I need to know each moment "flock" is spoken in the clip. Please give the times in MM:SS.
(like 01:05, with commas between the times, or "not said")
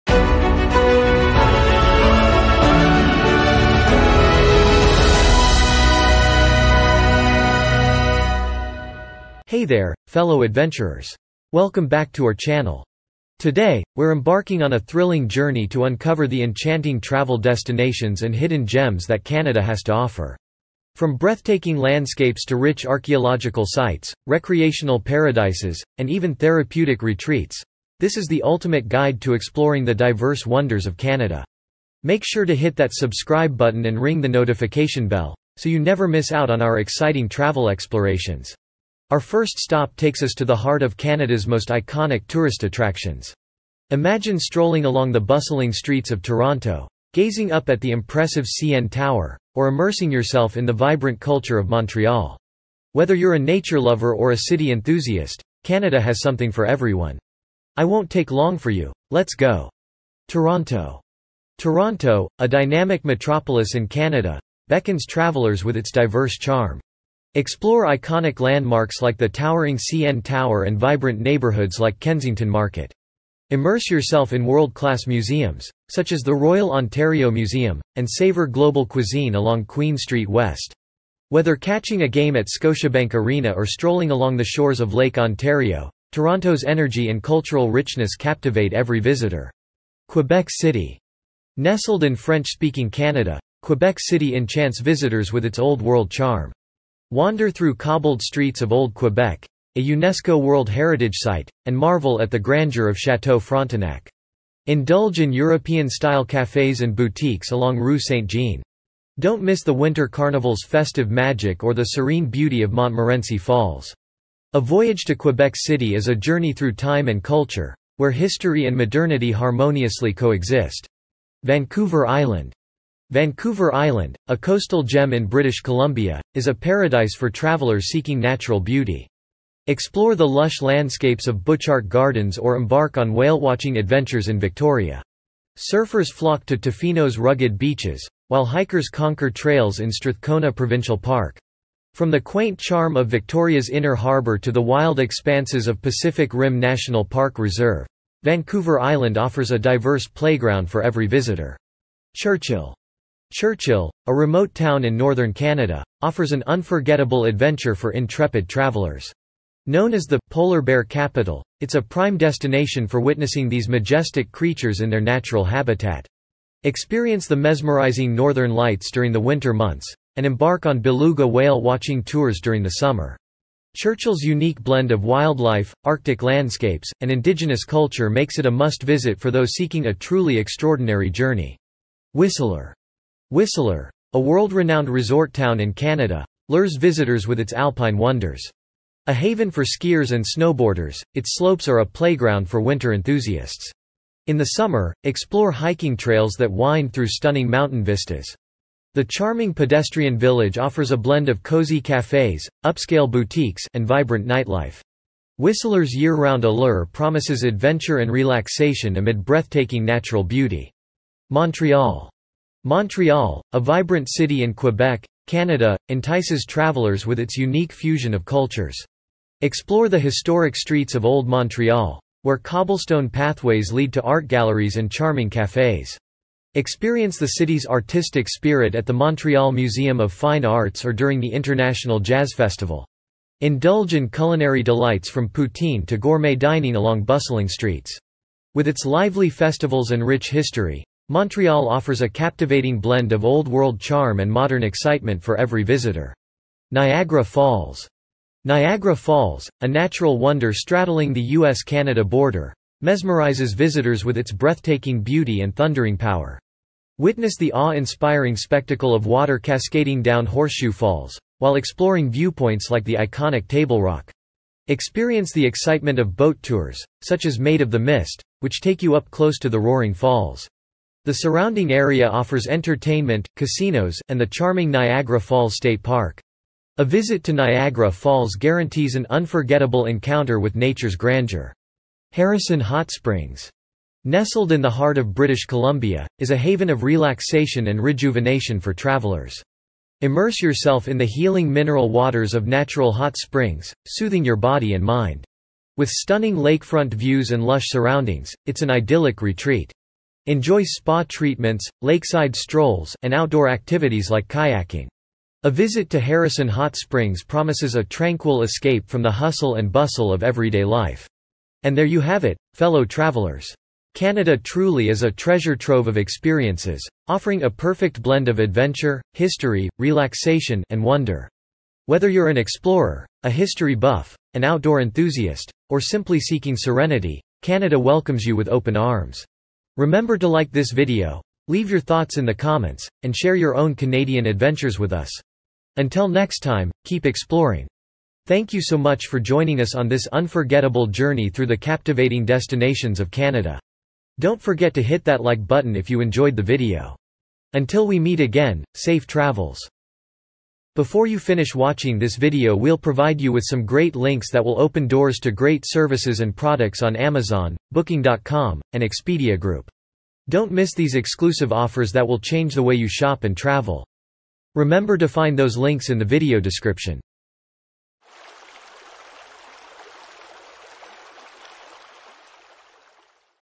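02:16.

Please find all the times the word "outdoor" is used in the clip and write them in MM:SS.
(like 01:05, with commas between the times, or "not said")
05:03, 05:24.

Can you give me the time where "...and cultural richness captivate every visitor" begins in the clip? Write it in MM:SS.
01:27.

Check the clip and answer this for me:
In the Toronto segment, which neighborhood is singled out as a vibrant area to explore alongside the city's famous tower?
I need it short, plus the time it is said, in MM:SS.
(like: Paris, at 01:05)
Kensington Market, at 01:12.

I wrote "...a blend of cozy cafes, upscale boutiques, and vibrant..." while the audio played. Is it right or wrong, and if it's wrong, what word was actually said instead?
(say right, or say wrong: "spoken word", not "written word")
right.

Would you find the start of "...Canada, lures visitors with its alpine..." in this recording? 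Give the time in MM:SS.
03:05.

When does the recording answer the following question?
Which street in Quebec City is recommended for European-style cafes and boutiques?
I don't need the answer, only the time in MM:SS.
01:47.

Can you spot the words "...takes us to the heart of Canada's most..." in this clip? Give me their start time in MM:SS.
00:39.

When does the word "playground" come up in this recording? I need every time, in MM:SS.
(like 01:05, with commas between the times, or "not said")
02:30, 03:11.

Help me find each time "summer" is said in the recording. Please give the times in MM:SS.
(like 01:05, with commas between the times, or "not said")
02:52, 03:14.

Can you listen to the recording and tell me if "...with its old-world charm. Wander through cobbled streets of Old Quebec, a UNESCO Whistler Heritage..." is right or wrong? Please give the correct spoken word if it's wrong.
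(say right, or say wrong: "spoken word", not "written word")
wrong: "World", not "Whistler".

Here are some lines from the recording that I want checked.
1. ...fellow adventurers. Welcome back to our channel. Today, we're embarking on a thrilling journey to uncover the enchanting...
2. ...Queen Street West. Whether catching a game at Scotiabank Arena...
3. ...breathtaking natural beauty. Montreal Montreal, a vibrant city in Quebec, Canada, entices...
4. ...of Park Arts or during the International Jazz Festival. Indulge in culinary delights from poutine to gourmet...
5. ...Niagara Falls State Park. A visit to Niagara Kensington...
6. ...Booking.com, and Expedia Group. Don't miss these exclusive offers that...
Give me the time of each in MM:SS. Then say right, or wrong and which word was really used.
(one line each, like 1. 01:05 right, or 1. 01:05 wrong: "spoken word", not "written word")
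1. 00:10 right
2. 01:19 right
3. 03:29 right
4. 03:49 wrong: "Fine", not "Park"
5. 04:34 wrong: "Falls", not "Kensington"
6. 05:57 right.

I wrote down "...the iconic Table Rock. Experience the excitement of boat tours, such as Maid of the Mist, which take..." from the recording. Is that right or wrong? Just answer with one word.
right.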